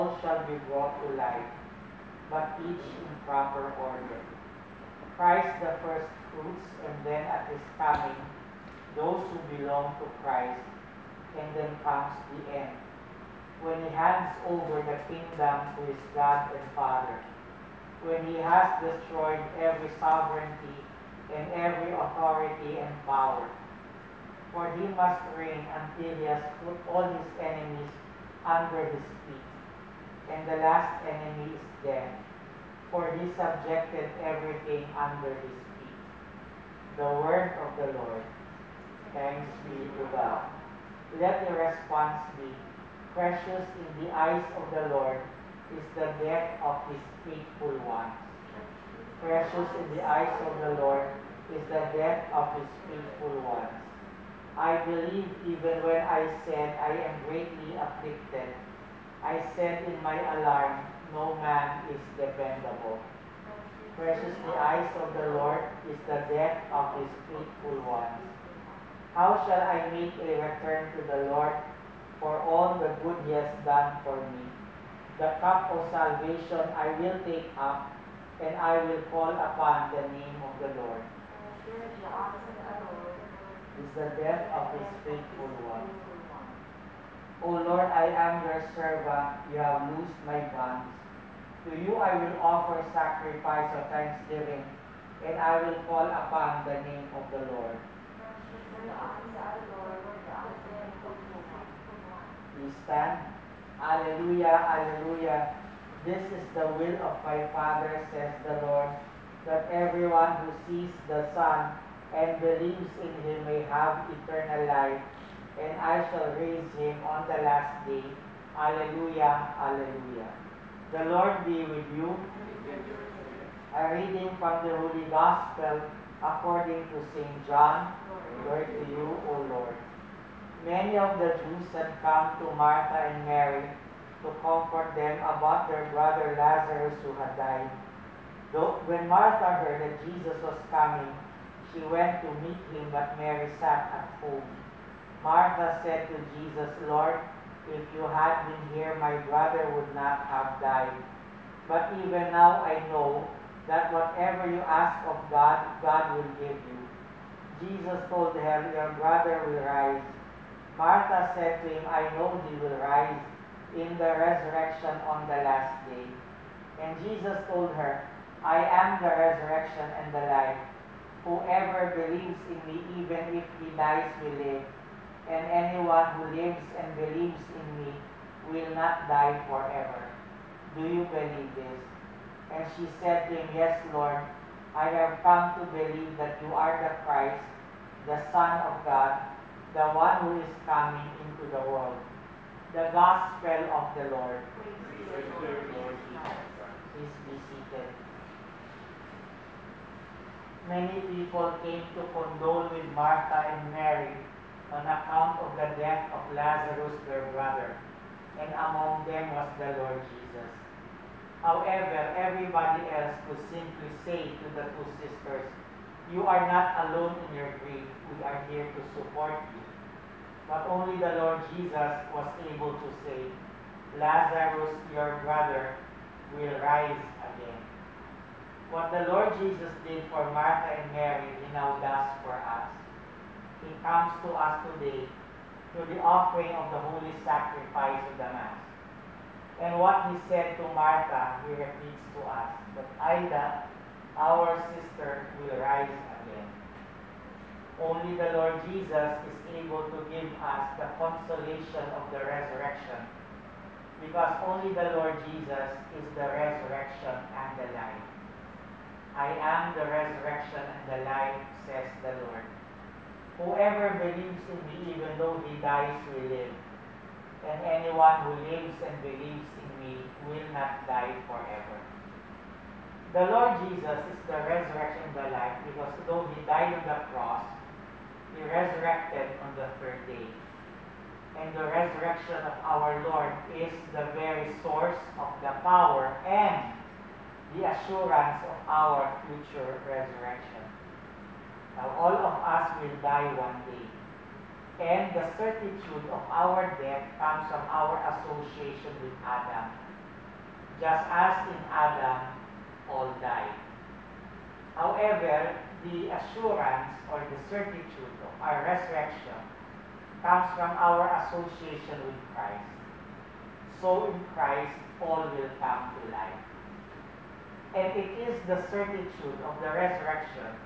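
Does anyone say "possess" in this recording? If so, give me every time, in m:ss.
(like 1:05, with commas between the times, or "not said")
not said.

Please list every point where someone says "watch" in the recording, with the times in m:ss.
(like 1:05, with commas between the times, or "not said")
not said.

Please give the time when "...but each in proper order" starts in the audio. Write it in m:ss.
0:02.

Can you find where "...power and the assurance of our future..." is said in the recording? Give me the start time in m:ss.
4:45.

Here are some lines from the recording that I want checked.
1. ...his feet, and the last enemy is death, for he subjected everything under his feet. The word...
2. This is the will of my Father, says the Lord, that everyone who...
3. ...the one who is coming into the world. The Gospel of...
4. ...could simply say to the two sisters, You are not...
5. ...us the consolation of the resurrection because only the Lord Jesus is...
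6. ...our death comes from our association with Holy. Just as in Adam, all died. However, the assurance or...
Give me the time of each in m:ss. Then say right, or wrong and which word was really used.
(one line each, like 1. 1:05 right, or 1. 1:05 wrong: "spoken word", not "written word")
1. 0:28 right
2. 1:46 right
3. 3:09 right
4. 3:33 right
5. 4:10 right
6. 4:56 wrong: "Adam", not "Holy".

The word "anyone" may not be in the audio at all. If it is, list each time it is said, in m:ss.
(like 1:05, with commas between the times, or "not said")
2:55, 4:27.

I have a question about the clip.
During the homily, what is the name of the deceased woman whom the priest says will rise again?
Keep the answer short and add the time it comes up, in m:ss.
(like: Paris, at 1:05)
Aida, at 4:02.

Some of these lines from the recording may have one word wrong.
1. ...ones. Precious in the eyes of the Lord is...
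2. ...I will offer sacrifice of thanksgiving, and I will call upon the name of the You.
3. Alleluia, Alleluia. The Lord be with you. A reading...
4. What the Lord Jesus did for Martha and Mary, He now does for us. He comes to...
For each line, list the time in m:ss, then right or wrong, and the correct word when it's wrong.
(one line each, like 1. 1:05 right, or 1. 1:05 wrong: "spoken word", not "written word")
1. 0:47 right
2. 1:31 wrong: "Lord", not "You"
3. 1:58 right
4. 3:48 right.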